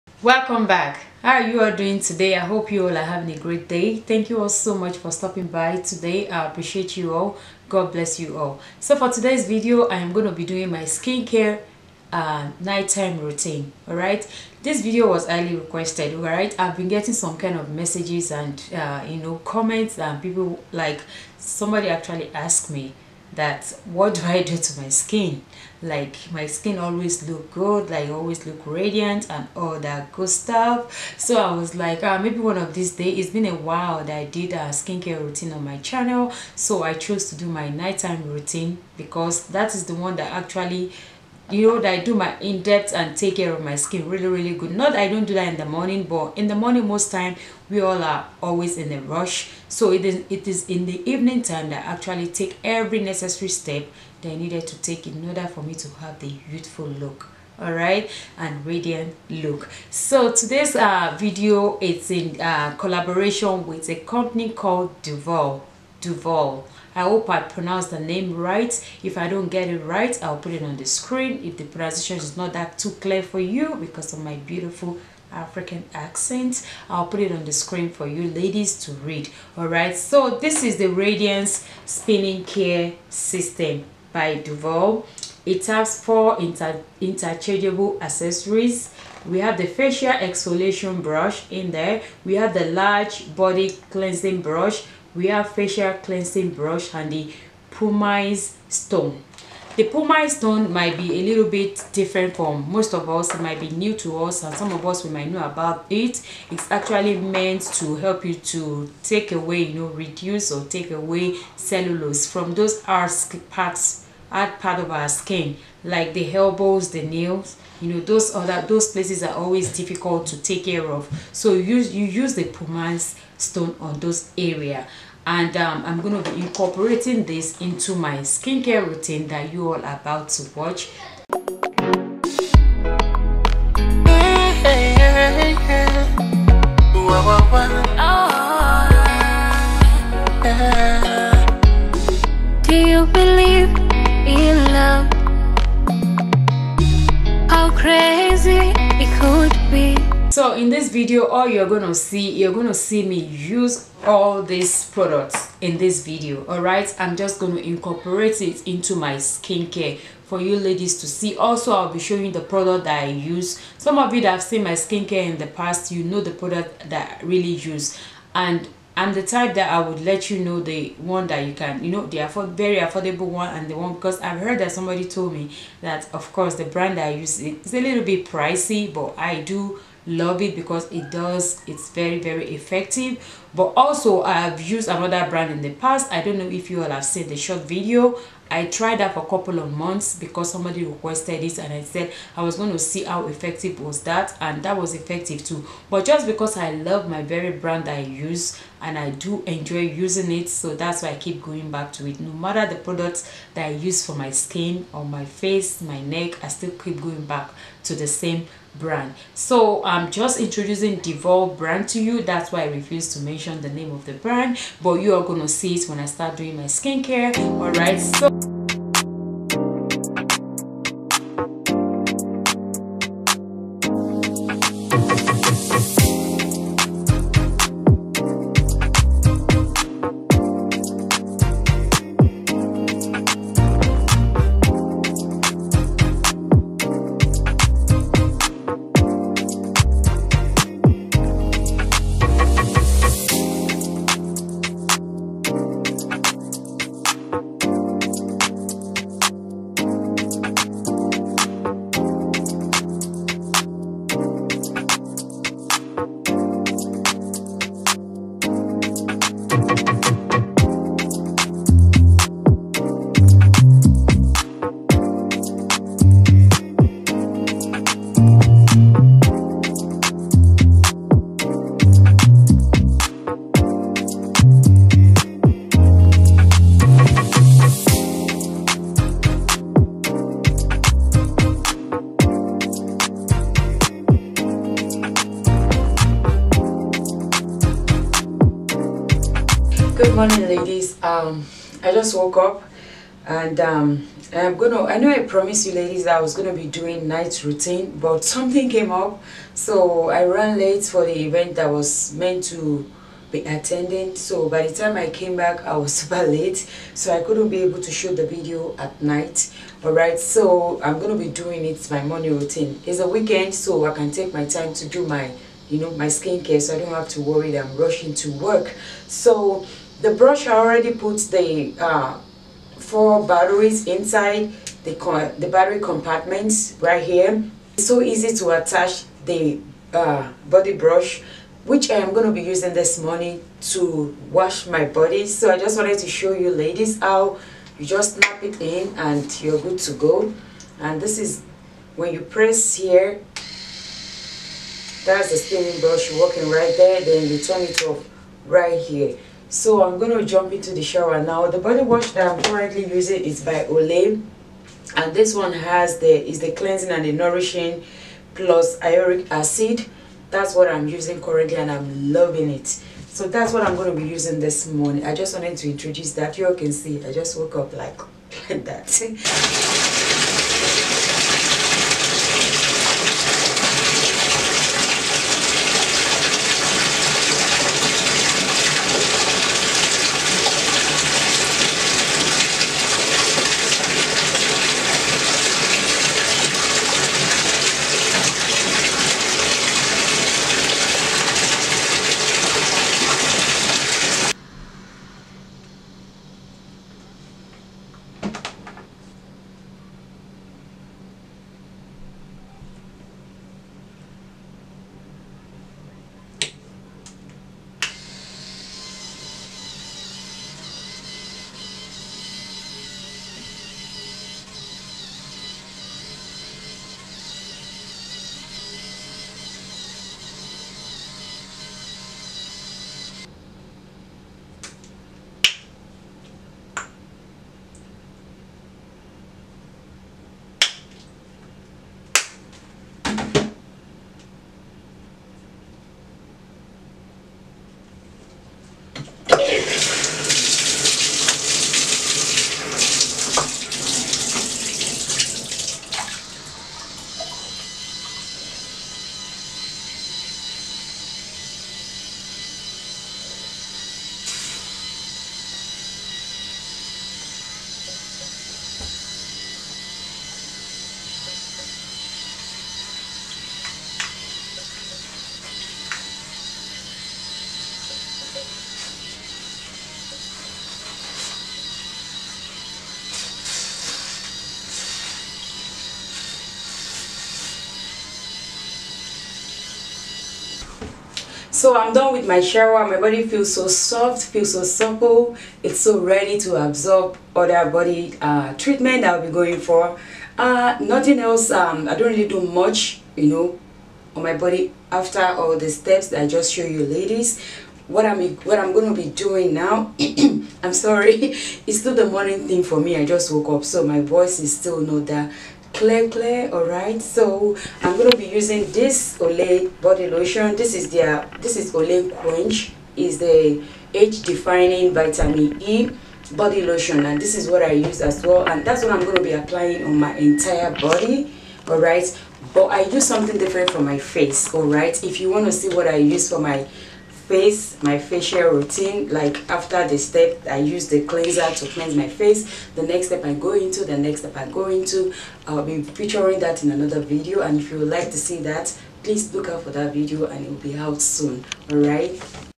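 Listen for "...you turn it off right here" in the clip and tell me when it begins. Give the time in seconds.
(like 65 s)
347 s.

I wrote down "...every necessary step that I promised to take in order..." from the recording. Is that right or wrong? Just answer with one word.
wrong.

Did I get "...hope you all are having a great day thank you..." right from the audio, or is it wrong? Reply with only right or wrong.
right.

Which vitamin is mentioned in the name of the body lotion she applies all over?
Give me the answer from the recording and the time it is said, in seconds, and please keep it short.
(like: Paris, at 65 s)
vitamin E, at 514 s.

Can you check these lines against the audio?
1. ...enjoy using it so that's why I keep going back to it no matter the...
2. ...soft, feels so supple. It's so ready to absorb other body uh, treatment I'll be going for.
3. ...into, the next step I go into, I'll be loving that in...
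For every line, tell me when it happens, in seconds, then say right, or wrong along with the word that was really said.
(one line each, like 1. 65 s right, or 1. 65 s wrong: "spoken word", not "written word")
1. 199 s right
2. 483 s right
3. 533 s wrong: "featuring", not "loving".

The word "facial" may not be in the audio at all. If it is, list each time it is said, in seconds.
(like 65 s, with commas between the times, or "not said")
89 s, 95 s, 527 s.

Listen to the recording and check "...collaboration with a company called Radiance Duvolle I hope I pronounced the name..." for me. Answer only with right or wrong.
wrong.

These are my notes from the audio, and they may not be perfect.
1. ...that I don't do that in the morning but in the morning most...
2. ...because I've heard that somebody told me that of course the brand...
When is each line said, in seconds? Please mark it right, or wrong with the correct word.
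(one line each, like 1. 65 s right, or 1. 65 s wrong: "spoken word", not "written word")
1. 44 s right
2. 173 s right.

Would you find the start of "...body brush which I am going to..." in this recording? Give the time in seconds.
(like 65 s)
330 s.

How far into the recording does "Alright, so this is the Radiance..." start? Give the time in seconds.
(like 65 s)
79 s.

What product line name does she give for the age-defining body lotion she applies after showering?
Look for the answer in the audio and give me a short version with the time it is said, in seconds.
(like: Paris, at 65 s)
Quench, at 512 s.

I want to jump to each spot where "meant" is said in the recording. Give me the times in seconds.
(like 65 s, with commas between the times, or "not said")
107 s, 302 s.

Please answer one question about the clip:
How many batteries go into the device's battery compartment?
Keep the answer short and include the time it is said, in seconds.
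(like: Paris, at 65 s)
4, at 322 s.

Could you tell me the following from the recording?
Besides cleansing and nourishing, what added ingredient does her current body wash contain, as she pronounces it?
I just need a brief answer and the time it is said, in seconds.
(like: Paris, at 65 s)
iuric acid, at 358 s.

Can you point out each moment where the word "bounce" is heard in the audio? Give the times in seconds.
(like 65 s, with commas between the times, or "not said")
not said.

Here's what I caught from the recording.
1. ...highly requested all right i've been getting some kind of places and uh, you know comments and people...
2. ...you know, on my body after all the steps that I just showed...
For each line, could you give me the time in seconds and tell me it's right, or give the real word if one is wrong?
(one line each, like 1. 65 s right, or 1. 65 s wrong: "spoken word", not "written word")
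1. 15 s wrong: "messages", not "places"
2. 493 s right.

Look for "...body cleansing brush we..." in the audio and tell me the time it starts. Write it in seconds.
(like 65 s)
93 s.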